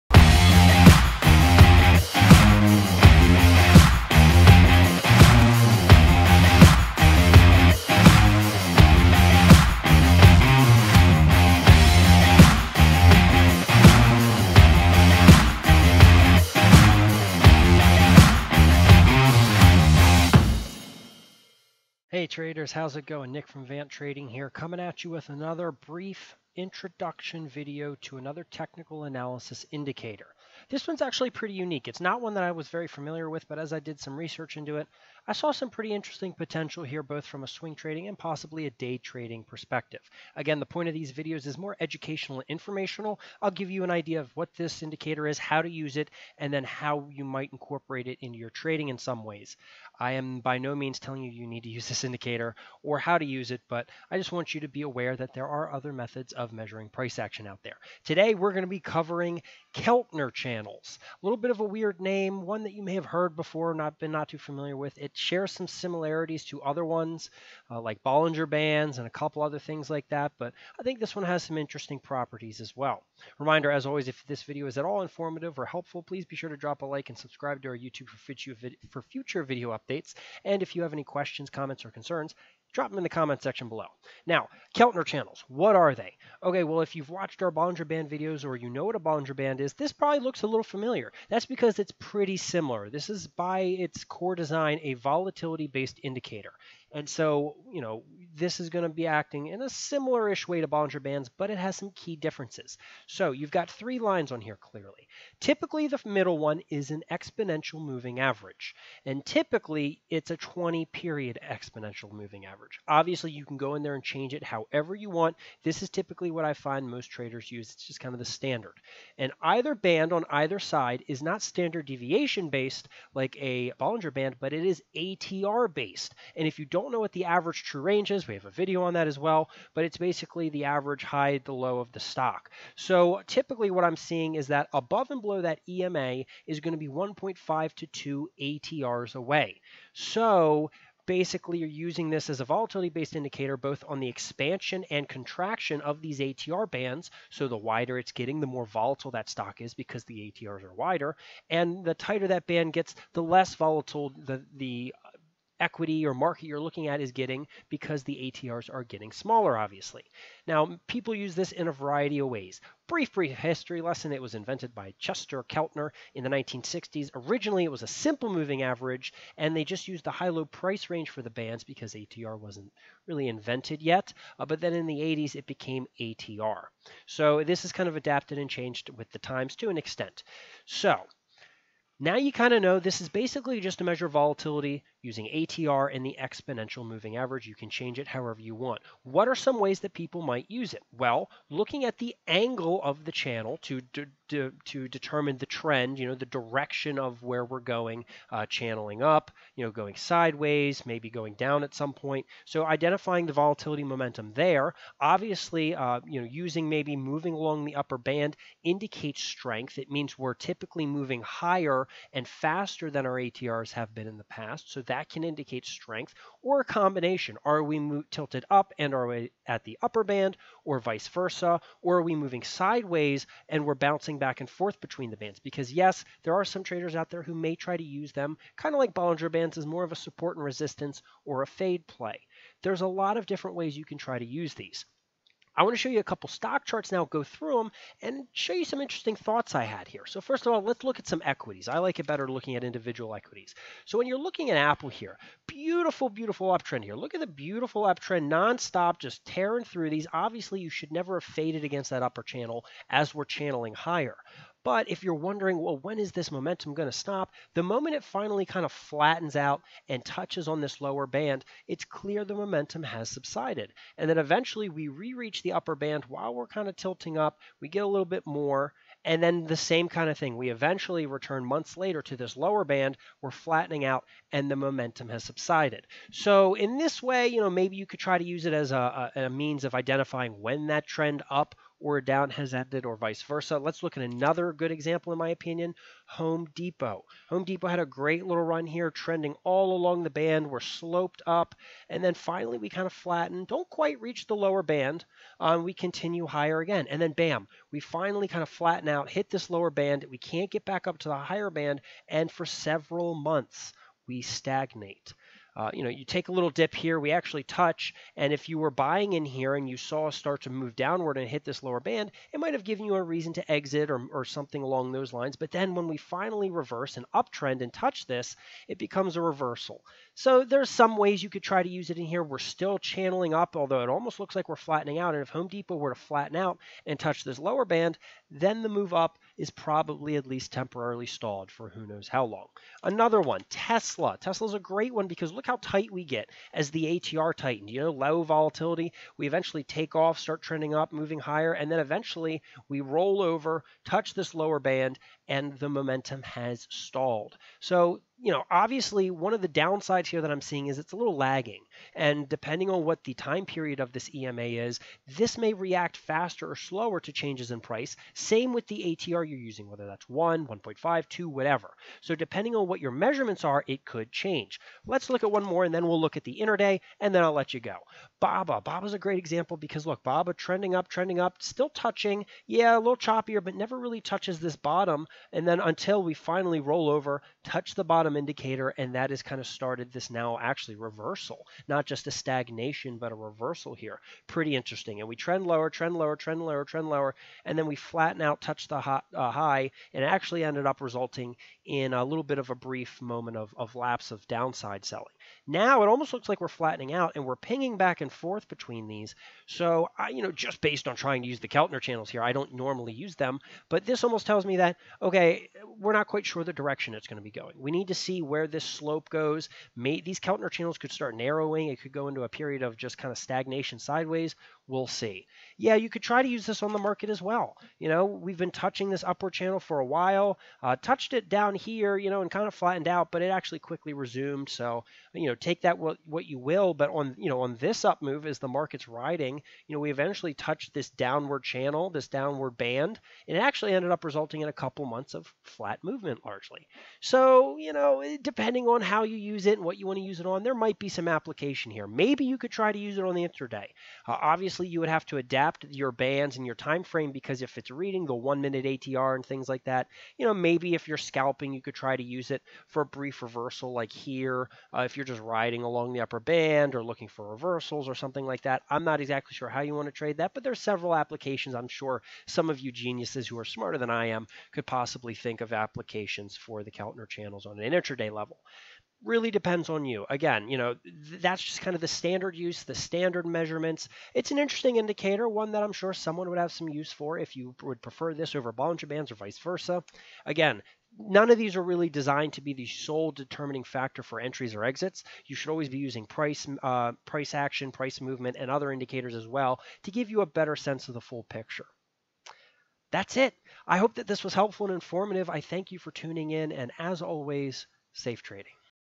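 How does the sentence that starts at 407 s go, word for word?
We need to see where this slope goes.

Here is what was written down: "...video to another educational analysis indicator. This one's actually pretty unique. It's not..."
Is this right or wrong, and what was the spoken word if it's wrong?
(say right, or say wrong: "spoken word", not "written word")
wrong: "technical", not "educational".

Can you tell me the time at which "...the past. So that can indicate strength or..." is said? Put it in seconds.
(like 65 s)
214 s.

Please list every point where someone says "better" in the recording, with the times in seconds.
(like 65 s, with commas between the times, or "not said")
242 s, 490 s.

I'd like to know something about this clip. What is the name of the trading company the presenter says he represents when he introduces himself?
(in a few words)
Vant Trading.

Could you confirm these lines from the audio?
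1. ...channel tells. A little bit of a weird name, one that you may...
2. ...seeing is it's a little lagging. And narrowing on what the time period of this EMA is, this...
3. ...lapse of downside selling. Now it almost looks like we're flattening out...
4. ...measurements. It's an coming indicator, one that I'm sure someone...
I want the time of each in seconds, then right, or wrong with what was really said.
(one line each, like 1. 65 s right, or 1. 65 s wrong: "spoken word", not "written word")
1. 60 s wrong: "channels", not "tells"
2. 350 s wrong: "depending", not "narrowing"
3. 393 s right
4. 473 s wrong: "interesting", not "coming".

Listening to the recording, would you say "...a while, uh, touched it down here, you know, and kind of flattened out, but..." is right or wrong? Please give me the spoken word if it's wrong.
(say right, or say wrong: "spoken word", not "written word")
right.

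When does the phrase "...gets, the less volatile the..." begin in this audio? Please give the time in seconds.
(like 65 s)
152 s.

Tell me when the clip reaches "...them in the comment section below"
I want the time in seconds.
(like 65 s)
82 s.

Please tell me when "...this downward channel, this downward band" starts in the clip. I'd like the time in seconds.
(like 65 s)
430 s.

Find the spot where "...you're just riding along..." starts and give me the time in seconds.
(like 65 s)
454 s.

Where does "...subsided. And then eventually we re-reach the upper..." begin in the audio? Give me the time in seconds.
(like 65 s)
263 s.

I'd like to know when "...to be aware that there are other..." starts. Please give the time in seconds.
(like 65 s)
54 s.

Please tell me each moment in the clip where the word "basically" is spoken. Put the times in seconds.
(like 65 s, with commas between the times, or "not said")
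129 s, 141 s, 183 s.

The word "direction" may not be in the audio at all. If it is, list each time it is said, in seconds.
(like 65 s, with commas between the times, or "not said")
196 s, 406 s.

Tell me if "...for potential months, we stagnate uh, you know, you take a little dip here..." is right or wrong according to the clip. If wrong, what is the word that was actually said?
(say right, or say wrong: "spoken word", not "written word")
wrong: "several", not "potential".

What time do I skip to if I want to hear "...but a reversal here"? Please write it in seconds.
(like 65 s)
382 s.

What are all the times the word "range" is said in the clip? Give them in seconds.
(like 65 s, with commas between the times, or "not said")
127 s, 170 s.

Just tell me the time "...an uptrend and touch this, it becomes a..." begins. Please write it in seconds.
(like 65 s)
316 s.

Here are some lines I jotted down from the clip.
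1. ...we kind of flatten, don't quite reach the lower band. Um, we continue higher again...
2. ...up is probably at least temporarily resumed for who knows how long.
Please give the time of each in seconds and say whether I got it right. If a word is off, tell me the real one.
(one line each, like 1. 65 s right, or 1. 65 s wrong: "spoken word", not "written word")
1. 292 s right
2. 328 s wrong: "stalled", not "resumed".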